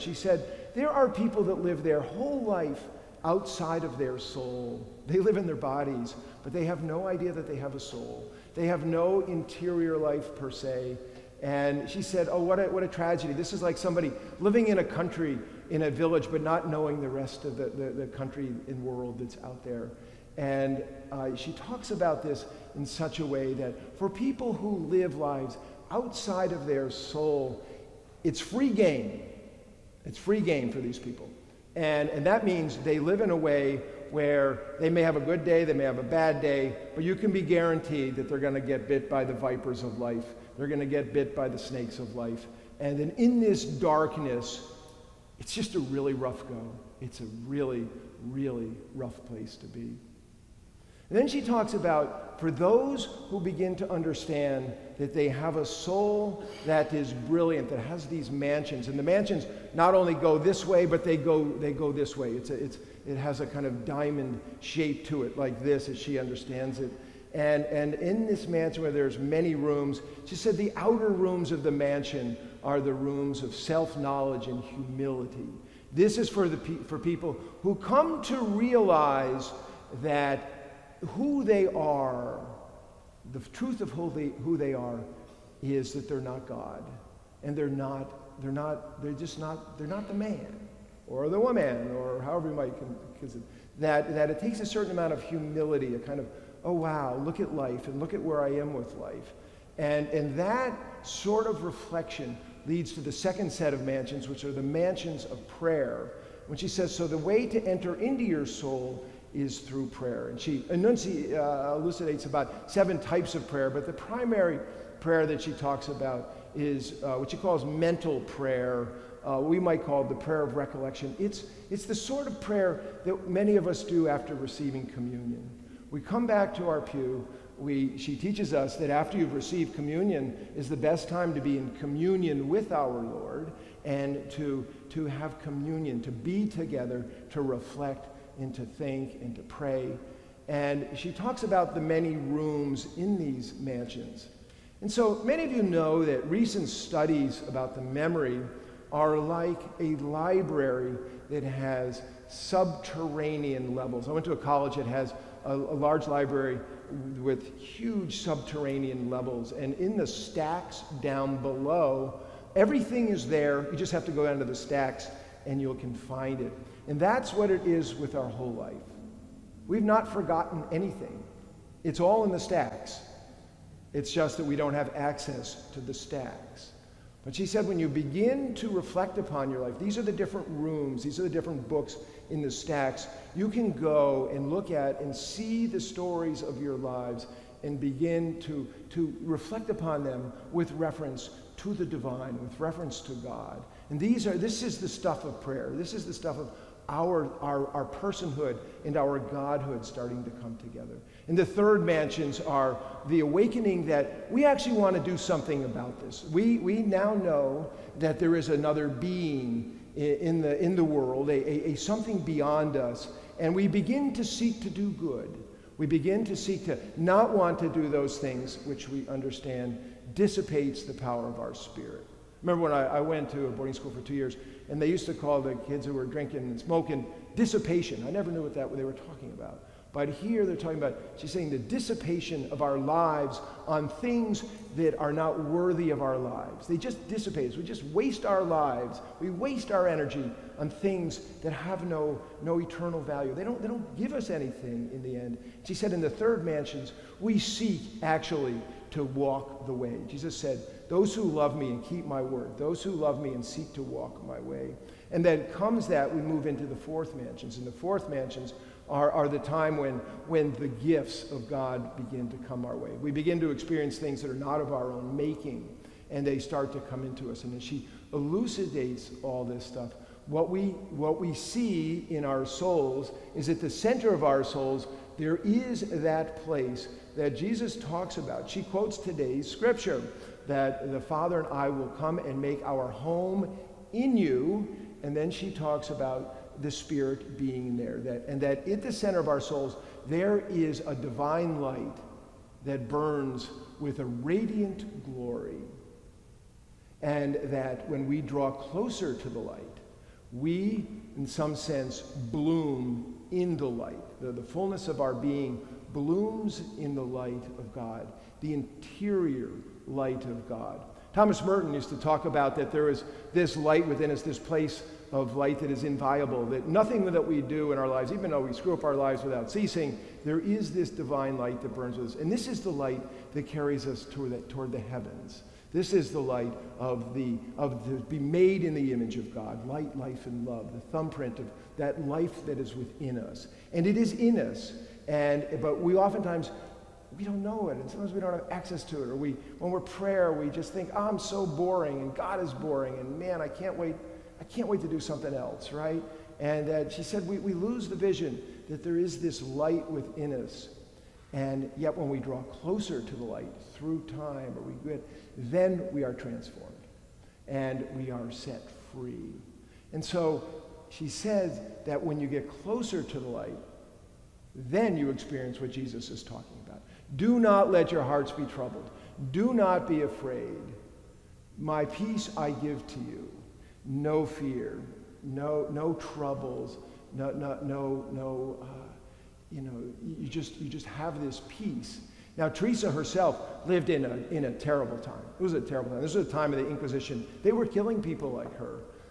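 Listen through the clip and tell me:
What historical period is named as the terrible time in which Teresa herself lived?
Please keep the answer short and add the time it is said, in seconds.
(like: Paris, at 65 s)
the Inquisition, at 386 s.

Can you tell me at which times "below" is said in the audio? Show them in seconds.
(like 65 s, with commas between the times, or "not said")
161 s.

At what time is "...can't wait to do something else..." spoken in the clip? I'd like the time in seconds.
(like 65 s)
344 s.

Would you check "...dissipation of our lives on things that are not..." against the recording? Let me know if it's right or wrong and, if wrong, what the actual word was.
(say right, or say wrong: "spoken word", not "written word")
right.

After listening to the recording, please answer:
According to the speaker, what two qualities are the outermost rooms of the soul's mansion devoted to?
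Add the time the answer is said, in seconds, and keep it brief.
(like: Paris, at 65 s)
self-knowledge and humility, at 73 s.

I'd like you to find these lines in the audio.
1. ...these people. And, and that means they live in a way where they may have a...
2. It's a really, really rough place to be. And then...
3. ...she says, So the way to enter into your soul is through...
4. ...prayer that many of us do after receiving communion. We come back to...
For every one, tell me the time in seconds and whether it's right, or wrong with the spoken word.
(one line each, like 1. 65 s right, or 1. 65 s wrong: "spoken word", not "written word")
1. 30 s right
2. 47 s right
3. 106 s right
4. 122 s right.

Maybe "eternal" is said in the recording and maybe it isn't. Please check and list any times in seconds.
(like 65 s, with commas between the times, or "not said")
242 s.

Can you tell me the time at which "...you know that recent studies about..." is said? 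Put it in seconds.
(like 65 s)
145 s.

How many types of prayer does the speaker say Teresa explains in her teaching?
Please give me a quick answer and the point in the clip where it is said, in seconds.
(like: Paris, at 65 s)
7, at 112 s.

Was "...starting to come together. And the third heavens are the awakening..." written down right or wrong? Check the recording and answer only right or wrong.
wrong.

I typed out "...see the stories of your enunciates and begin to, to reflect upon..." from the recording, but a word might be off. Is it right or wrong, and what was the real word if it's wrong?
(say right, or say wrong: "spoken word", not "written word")
wrong: "lives", not "enunciates".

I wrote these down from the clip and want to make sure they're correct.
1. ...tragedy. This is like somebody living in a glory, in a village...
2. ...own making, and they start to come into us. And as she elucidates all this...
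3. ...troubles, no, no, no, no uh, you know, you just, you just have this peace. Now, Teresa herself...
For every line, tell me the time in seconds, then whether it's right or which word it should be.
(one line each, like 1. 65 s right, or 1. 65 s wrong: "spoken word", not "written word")
1. 12 s wrong: "country", not "glory"
2. 264 s right
3. 375 s right.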